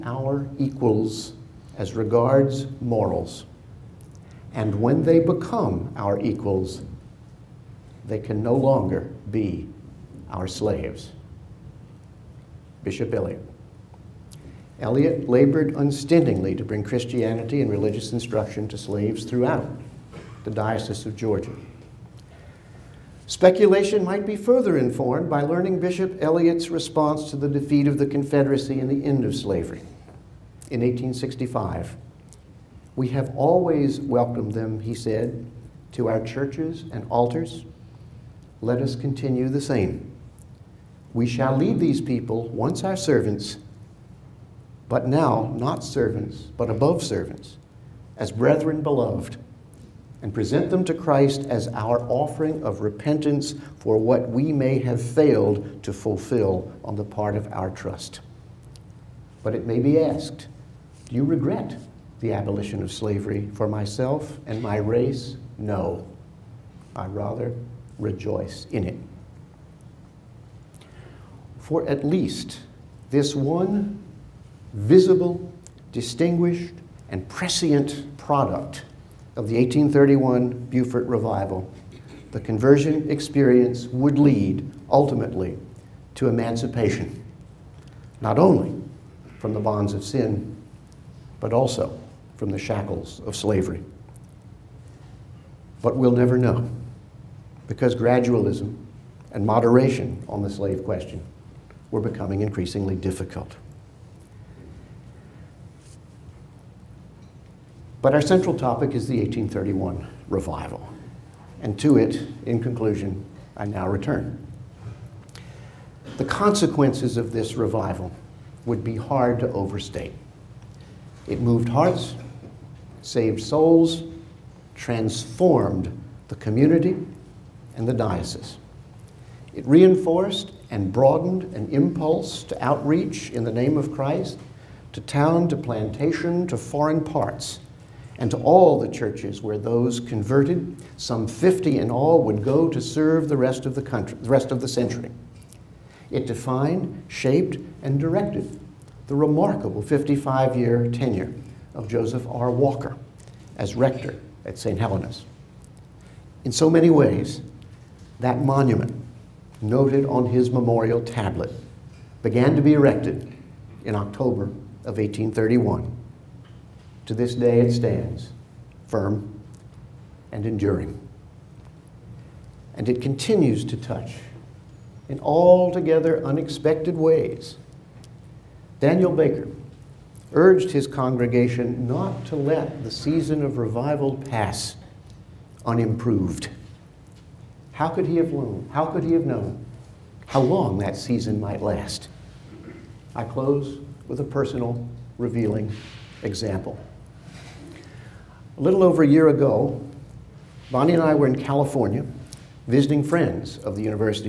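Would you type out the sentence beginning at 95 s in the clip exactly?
But we'll never know because gradualism and moderation on the slave question were becoming increasingly difficult.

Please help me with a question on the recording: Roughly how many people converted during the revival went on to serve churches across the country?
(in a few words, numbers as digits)
50.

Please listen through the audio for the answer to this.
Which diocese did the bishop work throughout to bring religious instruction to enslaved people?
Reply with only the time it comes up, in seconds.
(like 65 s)
20 s.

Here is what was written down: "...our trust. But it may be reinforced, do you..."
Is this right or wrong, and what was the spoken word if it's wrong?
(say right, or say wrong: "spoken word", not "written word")
wrong: "asked", not "reinforced".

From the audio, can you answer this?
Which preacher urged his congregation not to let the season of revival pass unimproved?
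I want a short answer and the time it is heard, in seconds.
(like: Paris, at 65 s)
Daniel Baker, at 178 s.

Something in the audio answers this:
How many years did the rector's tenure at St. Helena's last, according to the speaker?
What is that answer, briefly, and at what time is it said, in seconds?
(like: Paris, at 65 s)
55, at 149 s.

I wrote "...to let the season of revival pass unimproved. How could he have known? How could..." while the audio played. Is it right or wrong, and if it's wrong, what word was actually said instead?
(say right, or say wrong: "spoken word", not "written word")
right.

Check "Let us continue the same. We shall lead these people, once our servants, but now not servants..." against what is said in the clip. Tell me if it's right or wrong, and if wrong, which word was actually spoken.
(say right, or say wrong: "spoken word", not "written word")
right.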